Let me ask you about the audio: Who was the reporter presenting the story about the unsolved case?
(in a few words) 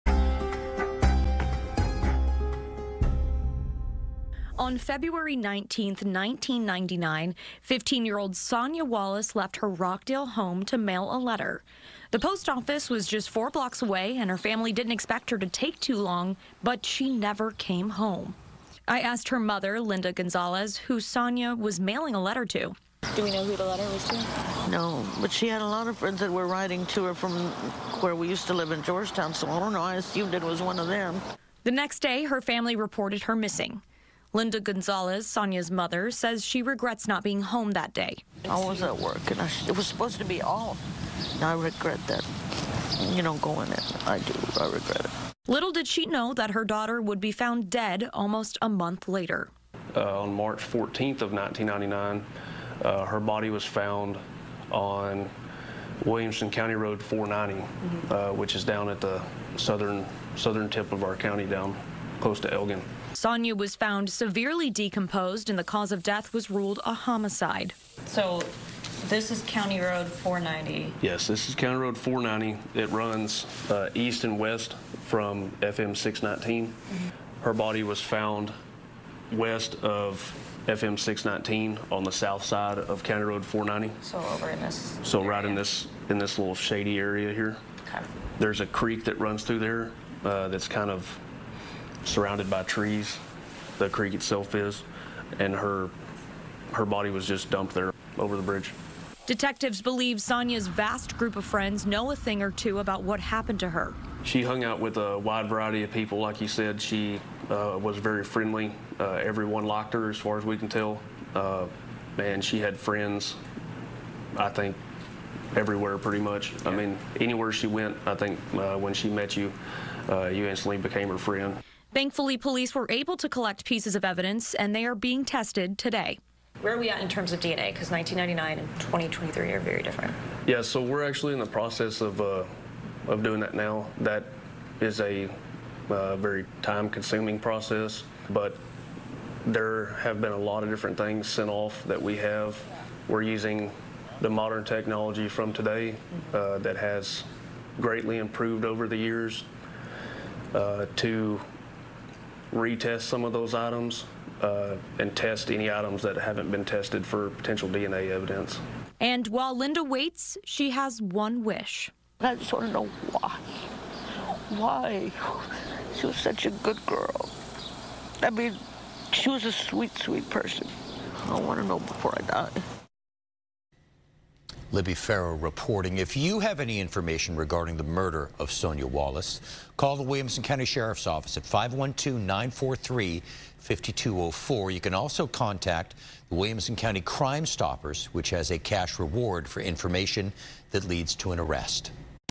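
Libbi Farrow.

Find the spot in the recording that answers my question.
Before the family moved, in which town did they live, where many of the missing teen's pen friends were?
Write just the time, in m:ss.
0:28.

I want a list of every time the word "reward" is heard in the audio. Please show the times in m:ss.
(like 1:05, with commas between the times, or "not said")
3:08.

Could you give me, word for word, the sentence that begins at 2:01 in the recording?
Thankfully, police were able to collect pieces of evidence and they are being tested today.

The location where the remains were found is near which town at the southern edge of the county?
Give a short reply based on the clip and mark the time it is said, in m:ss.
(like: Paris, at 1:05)
Elgin, at 1:02.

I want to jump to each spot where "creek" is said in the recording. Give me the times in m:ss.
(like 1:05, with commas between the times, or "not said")
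1:28, 1:33.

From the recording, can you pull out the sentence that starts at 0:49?
Uh, on March 14th of 1999, uh, her body was found on Williamson County Road 490, mm -hmm.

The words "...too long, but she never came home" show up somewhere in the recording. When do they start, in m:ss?
0:15.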